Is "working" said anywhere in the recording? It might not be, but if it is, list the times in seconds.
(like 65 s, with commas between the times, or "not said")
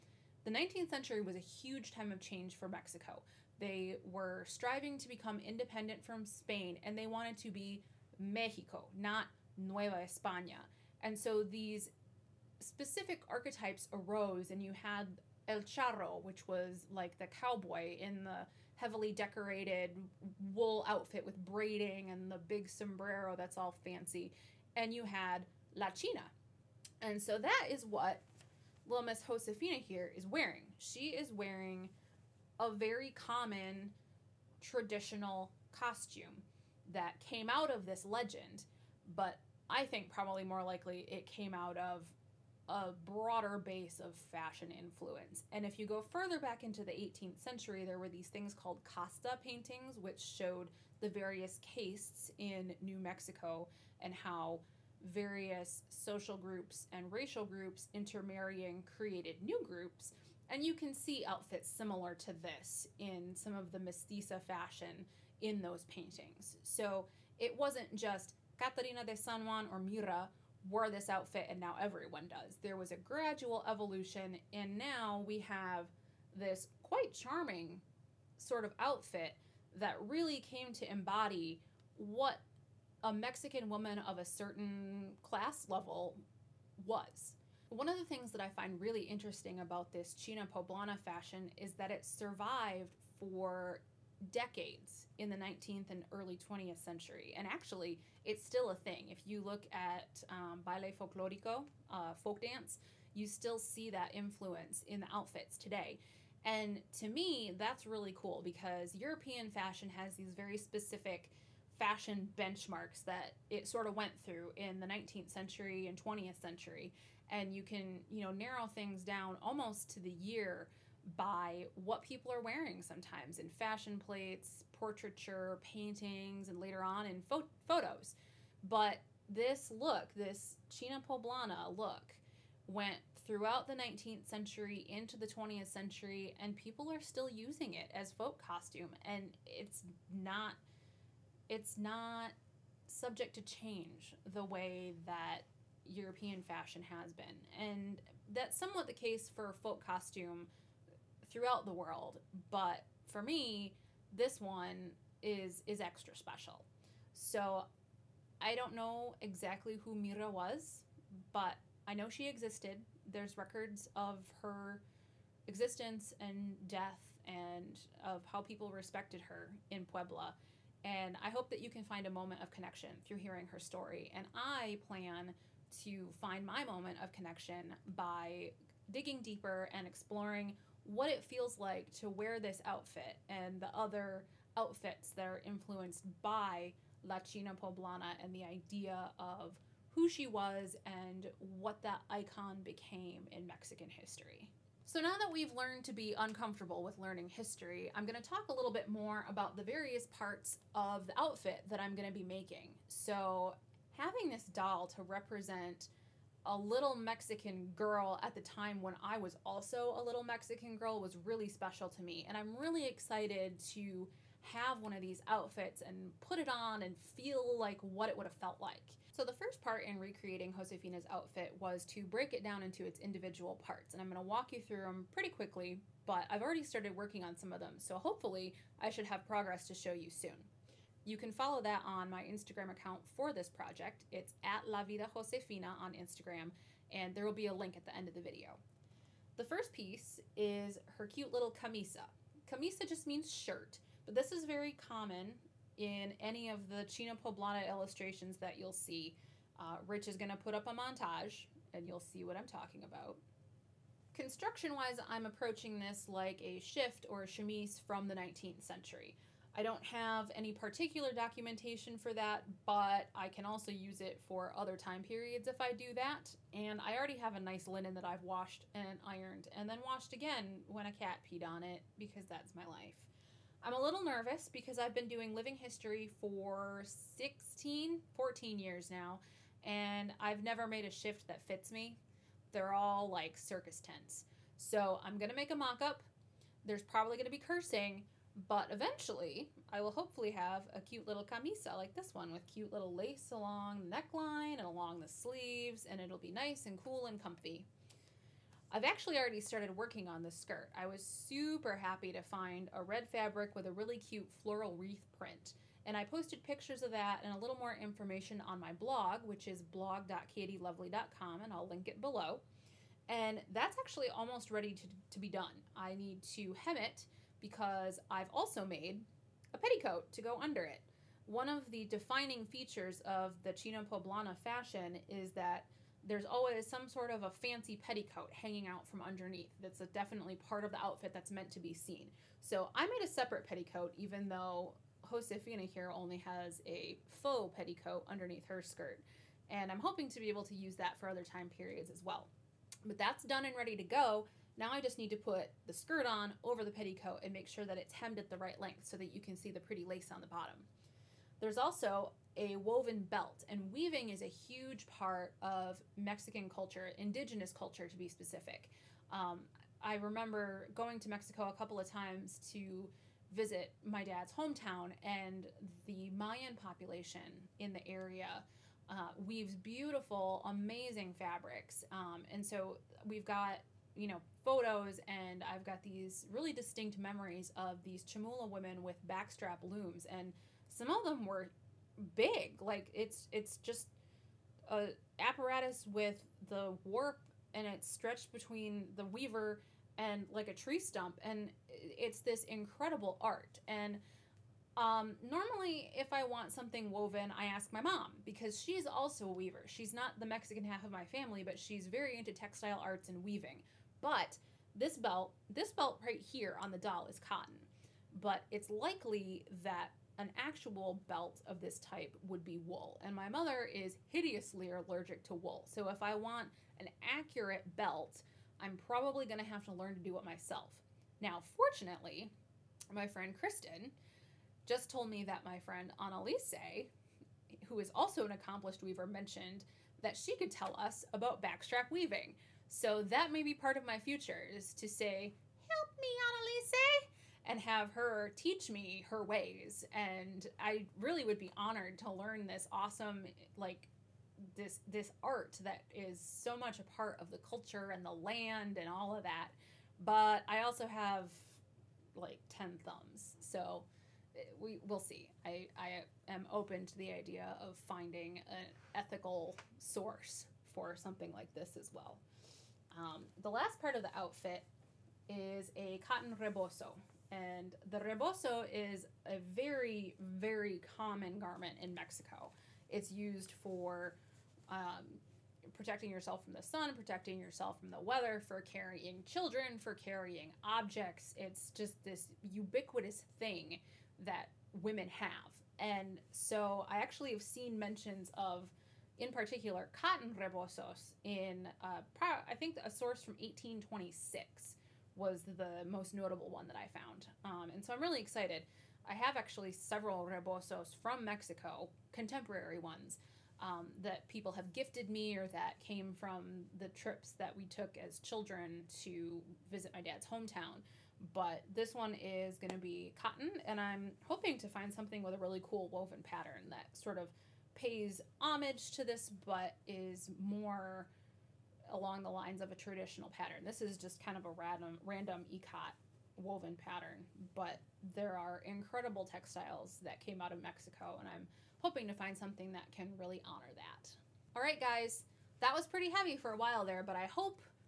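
226 s, 299 s.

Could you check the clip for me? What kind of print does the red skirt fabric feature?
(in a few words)
floral wreath.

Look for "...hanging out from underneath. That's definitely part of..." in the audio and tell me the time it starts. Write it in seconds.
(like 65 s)
328 s.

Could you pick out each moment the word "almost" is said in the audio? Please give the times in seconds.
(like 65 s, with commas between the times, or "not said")
119 s, 314 s.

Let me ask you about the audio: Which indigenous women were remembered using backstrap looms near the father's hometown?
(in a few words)
Chamula.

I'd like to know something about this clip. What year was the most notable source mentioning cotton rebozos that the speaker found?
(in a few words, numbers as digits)
1826.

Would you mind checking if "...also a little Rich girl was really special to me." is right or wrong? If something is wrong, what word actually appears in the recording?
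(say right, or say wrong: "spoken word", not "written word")
wrong: "Mexican", not "Rich".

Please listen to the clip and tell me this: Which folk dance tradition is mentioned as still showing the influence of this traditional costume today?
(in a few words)
baile folklorico.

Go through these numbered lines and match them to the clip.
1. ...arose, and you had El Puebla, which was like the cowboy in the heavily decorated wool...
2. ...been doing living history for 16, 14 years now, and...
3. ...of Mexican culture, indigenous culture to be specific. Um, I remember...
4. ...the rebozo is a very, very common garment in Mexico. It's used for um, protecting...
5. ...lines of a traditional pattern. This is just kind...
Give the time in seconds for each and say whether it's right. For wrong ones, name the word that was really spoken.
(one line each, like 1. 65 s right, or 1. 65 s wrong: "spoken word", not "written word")
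1. 13 s wrong: "Charro", not "Puebla"
2. 274 s right
3. 355 s right
4. 467 s right
5. 522 s right.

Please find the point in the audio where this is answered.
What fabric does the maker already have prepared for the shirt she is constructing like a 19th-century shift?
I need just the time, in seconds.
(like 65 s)
267 s.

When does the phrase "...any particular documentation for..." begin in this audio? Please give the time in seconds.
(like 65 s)
260 s.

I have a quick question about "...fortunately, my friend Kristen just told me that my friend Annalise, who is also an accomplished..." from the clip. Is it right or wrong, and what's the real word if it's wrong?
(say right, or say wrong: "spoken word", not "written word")
right.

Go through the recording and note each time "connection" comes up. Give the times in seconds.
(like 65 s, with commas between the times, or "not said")
172 s, 177 s.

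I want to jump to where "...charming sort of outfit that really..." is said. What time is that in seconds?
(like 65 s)
77 s.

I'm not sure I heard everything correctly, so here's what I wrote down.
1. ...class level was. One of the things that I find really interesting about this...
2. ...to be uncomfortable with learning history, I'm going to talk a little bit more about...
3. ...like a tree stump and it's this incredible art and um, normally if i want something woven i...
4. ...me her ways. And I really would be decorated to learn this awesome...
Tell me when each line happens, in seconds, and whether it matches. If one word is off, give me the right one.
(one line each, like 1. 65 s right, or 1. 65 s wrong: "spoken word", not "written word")
1. 85 s right
2. 195 s right
3. 390 s right
4. 438 s wrong: "honored", not "decorated".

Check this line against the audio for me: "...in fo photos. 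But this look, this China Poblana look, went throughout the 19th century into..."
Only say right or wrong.
right.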